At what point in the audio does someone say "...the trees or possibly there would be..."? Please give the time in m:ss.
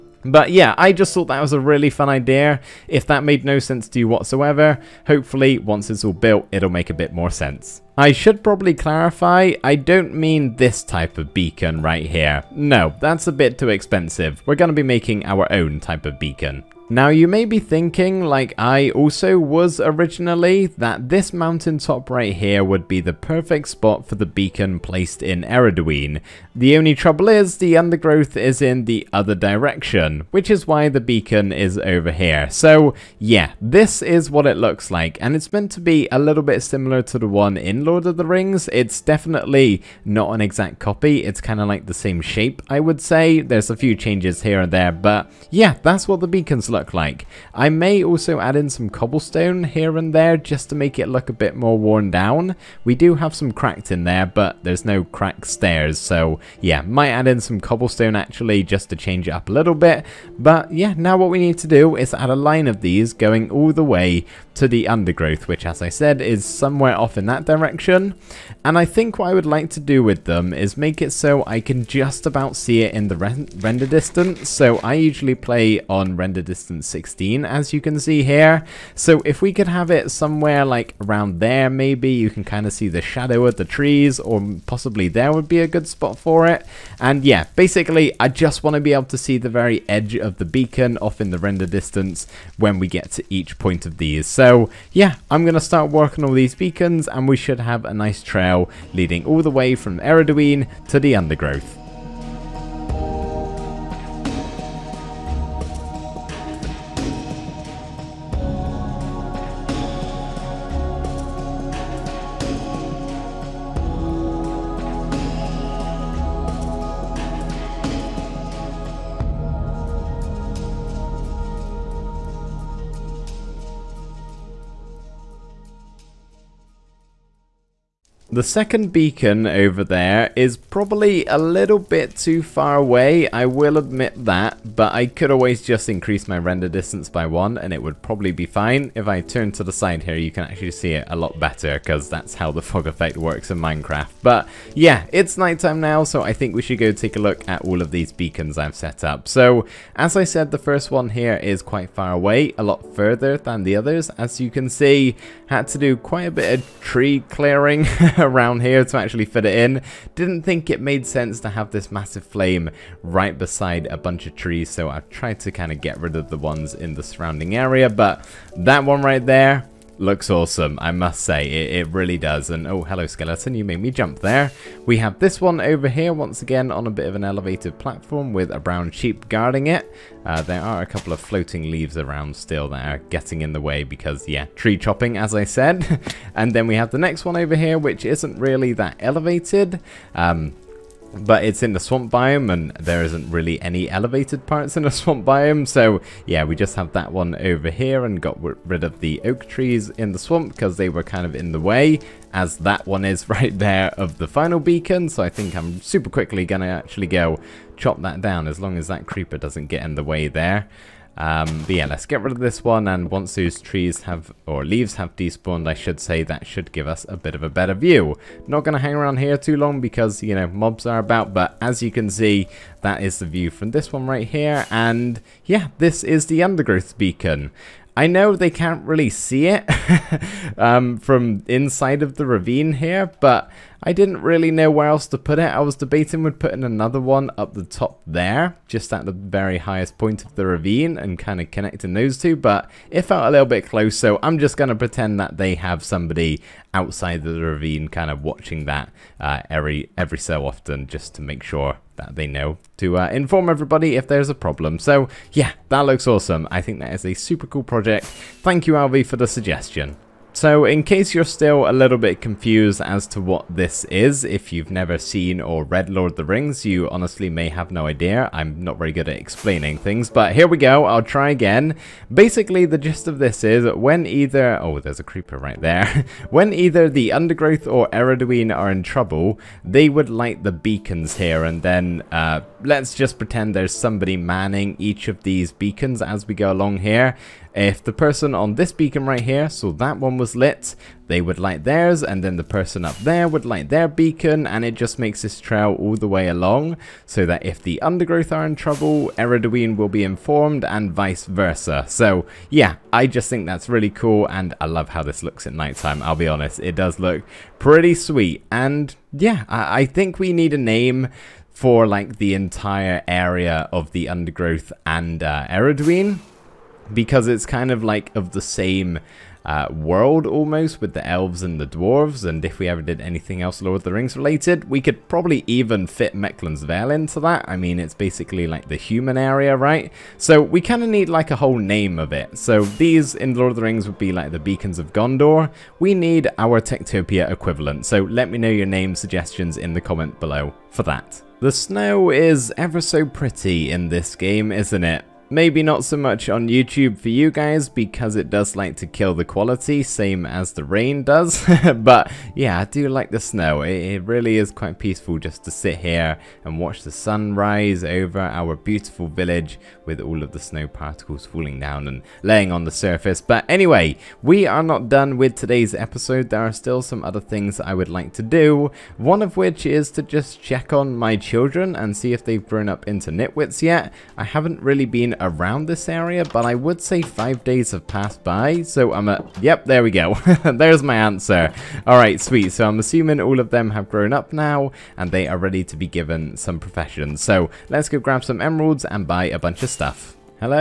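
1:23.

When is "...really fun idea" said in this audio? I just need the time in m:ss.
0:01.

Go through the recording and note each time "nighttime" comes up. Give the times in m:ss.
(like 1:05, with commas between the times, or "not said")
2:25, 5:05.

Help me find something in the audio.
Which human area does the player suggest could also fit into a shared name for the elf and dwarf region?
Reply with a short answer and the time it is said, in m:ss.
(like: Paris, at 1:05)
Mecklen's Vale, at 5:26.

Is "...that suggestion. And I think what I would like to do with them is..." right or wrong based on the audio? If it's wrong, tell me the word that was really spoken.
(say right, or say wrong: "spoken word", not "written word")
wrong: "direction", not "suggestion".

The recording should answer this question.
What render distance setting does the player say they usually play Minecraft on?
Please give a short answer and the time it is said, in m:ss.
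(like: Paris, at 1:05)
16, at 1:16.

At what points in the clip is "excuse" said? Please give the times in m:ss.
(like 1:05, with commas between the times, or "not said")
not said.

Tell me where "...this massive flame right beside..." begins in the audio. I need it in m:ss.
2:41.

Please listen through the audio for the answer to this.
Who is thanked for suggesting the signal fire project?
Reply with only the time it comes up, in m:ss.
4:18.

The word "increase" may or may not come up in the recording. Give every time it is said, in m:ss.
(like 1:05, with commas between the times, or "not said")
2:15.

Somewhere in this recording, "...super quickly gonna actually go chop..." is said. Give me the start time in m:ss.
3:25.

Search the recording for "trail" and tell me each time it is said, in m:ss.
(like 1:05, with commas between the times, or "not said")
1:38, 4:55.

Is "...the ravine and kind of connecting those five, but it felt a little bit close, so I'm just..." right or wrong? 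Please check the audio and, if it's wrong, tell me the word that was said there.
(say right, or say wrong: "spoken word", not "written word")
wrong: "two", not "five".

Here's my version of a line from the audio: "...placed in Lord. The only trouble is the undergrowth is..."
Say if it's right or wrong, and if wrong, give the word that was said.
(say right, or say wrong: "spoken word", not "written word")
wrong: "Ereduin", not "Lord".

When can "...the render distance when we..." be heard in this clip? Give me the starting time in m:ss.
1:31.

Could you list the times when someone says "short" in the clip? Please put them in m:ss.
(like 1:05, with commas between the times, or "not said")
not said.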